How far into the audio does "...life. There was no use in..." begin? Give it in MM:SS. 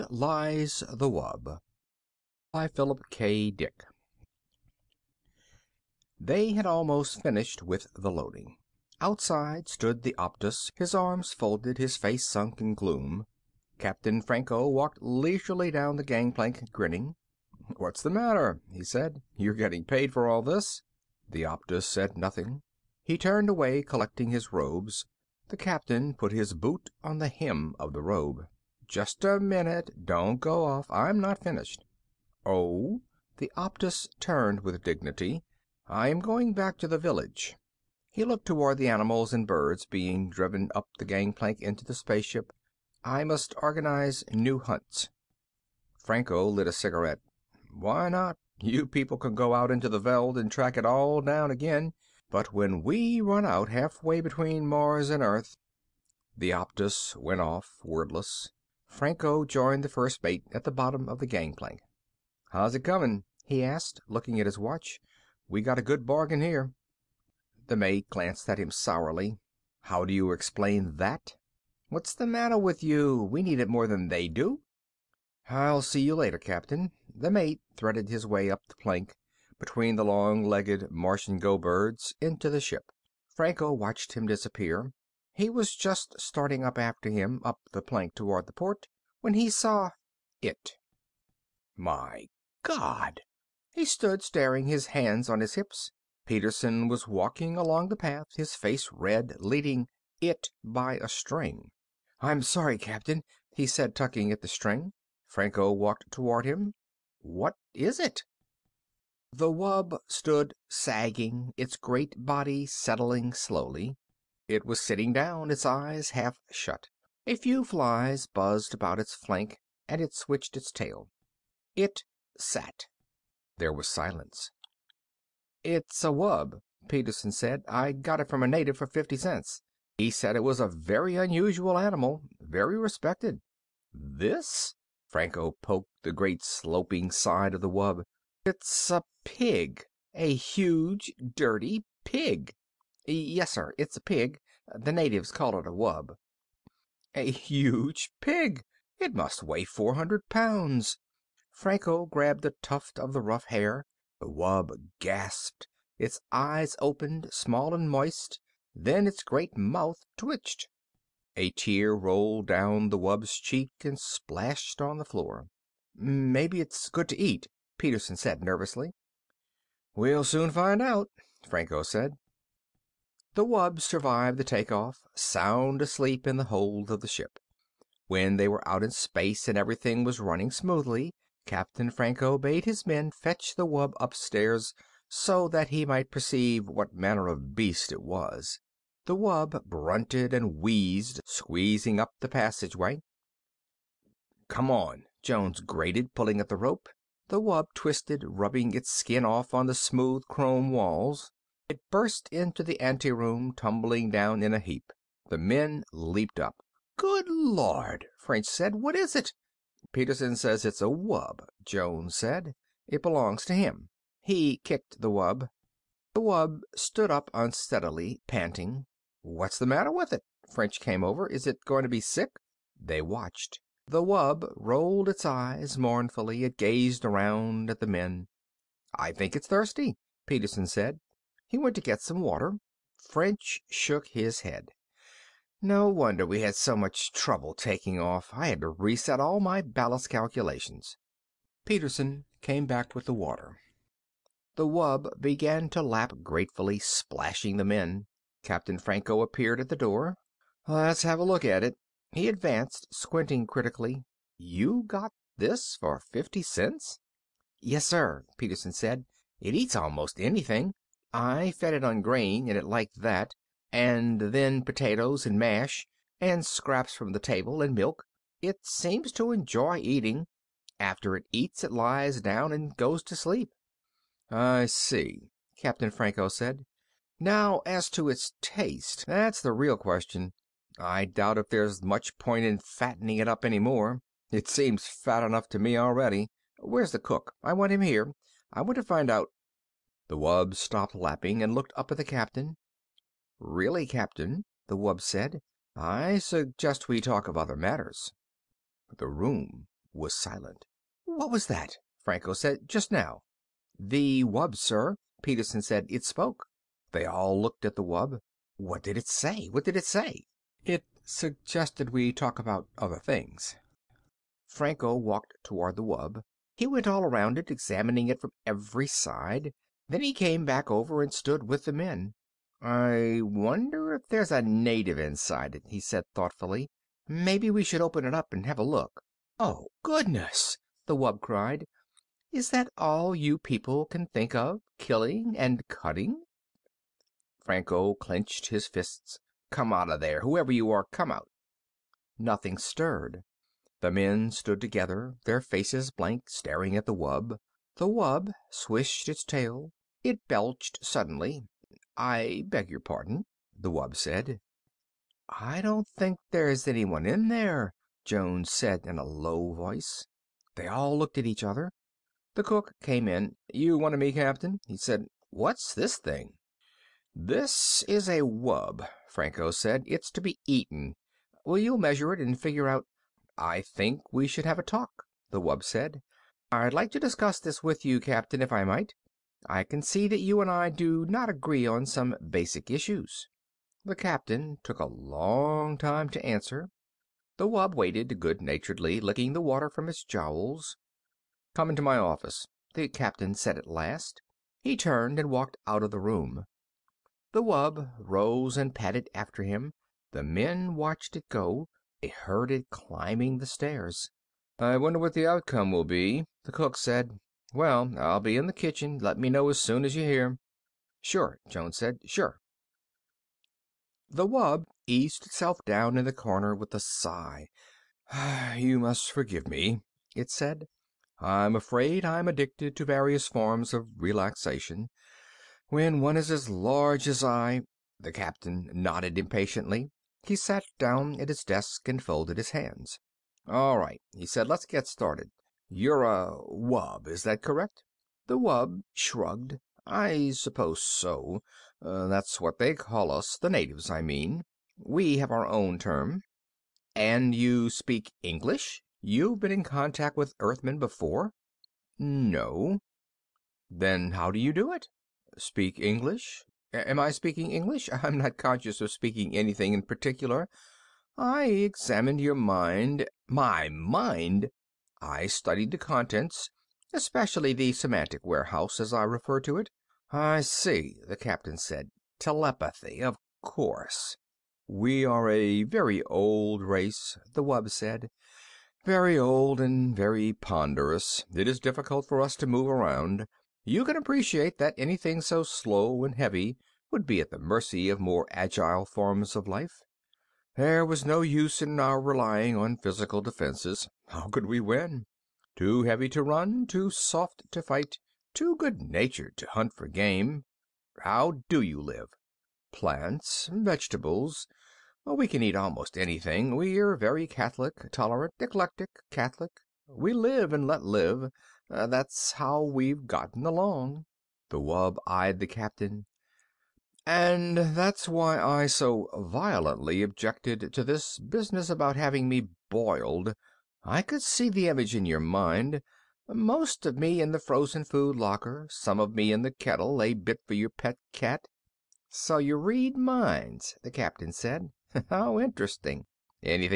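08:09.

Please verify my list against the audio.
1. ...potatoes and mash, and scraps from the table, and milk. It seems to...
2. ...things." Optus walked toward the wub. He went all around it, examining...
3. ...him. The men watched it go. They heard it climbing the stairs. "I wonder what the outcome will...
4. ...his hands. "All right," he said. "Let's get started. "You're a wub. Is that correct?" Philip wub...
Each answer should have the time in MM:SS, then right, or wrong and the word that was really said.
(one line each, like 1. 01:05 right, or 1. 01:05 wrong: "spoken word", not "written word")
1. 04:24 right
2. 05:12 wrong: "Franco", not "Optus"
3. 06:39 right
4. 07:12 wrong: "The", not "Philip".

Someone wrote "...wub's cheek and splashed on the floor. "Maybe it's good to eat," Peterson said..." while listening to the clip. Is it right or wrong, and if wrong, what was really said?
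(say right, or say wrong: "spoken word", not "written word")
right.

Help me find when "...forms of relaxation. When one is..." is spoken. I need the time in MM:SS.
07:03.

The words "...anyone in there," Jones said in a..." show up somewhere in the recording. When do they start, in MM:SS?
05:56.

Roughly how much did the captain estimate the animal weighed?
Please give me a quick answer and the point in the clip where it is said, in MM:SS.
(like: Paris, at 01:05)
400 pounds, at 02:29.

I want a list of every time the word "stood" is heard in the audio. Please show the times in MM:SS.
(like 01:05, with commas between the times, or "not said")
00:09, 01:33, 01:50, 03:36, 05:21, 05:44.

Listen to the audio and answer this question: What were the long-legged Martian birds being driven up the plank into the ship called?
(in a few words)
go birds.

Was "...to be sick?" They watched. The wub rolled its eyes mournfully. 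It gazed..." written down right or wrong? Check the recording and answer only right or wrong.
right.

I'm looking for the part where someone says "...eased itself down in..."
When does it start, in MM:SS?
06:54.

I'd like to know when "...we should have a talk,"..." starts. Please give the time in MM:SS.
06:14.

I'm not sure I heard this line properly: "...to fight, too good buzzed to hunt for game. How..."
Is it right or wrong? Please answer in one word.
wrong.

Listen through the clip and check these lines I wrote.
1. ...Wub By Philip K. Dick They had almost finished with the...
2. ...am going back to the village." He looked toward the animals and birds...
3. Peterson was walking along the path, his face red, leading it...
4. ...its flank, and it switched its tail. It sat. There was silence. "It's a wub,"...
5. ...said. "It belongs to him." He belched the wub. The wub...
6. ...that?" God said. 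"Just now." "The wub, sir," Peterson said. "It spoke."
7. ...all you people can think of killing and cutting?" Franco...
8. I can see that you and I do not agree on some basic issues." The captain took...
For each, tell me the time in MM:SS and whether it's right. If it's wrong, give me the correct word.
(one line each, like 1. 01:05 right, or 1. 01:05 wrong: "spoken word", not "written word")
1. 00:01 right
2. 00:36 right
3. 01:36 right
4. 01:58 right
5. 03:32 wrong: "kicked", not "belched"
6. 05:01 wrong: "Franco", not "God"
7. 05:32 right
8. 06:19 right.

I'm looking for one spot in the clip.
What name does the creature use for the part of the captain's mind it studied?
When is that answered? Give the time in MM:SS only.
07:47.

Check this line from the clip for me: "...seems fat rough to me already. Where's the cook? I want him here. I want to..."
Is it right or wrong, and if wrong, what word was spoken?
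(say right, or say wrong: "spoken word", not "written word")
wrong: "enough", not "rough".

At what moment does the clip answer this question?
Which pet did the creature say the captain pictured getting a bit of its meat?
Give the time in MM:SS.
08:51.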